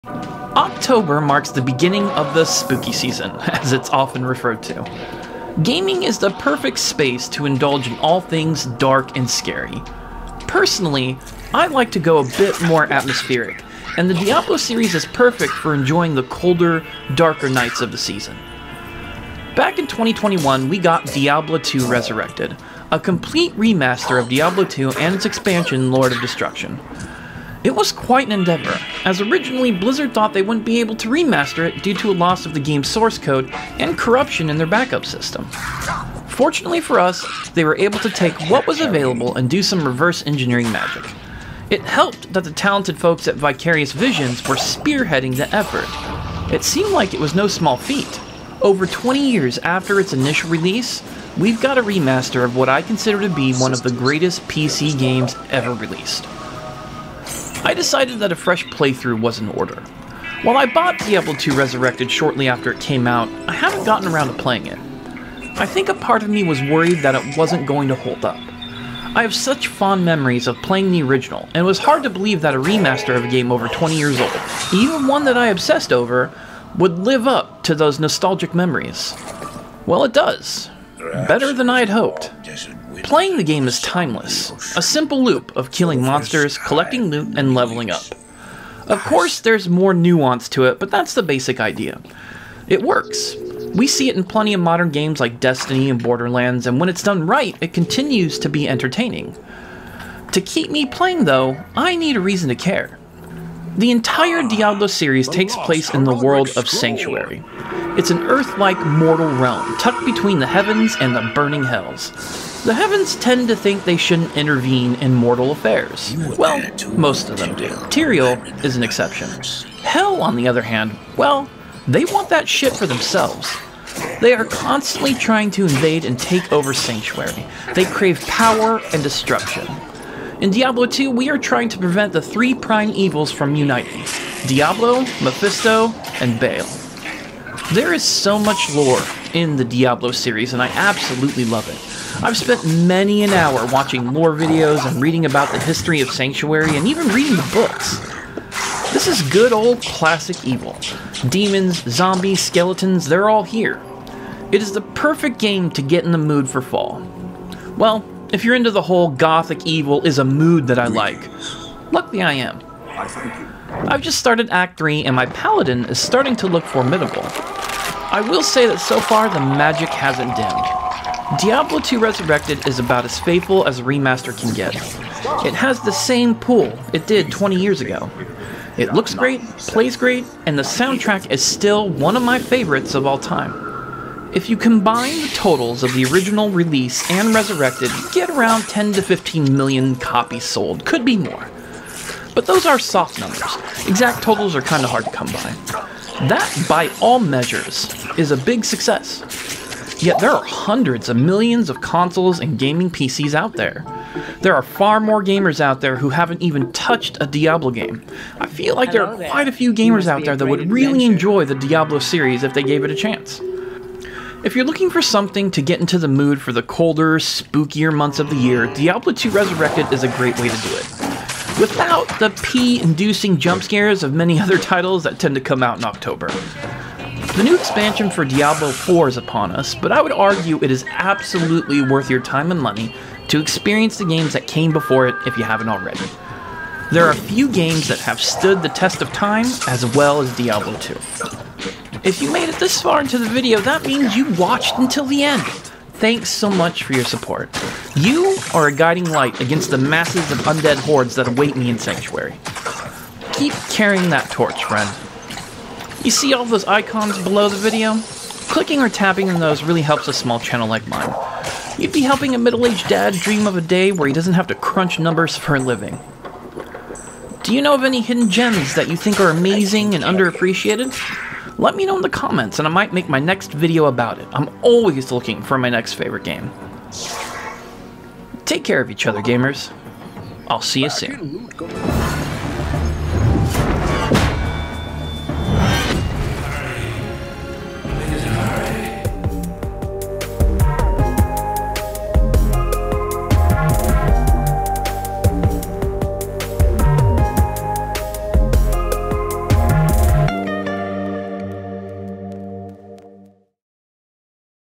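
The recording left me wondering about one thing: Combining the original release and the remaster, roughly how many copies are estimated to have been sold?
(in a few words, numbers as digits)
10 to 15 million.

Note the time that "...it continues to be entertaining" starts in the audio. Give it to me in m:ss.
1:37.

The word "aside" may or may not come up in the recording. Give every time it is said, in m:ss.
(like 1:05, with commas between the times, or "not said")
not said.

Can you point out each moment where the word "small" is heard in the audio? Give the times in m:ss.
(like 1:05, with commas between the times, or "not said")
0:47, 4:20.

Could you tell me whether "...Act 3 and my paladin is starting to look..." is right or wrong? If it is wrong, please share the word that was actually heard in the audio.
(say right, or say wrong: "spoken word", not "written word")
right.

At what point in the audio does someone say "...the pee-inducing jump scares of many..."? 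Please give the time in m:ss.
3:42.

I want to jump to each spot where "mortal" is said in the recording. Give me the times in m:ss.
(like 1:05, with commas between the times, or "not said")
1:48, 1:55.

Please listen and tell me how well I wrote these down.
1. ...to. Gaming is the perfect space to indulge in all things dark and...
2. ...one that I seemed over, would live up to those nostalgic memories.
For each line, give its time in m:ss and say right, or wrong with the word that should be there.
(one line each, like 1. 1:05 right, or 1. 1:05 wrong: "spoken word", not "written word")
1. 0:04 right
2. 1:15 wrong: "obsessed", not "seemed".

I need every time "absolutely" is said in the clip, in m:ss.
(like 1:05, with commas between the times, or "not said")
2:20, 3:50.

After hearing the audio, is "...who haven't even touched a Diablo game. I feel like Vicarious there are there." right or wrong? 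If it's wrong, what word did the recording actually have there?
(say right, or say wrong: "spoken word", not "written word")
wrong: "Hello", not "Vicarious".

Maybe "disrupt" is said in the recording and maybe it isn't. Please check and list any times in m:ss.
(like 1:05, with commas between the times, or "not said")
not said.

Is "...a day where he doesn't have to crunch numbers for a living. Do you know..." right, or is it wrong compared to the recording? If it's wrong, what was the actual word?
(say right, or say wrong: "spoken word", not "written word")
right.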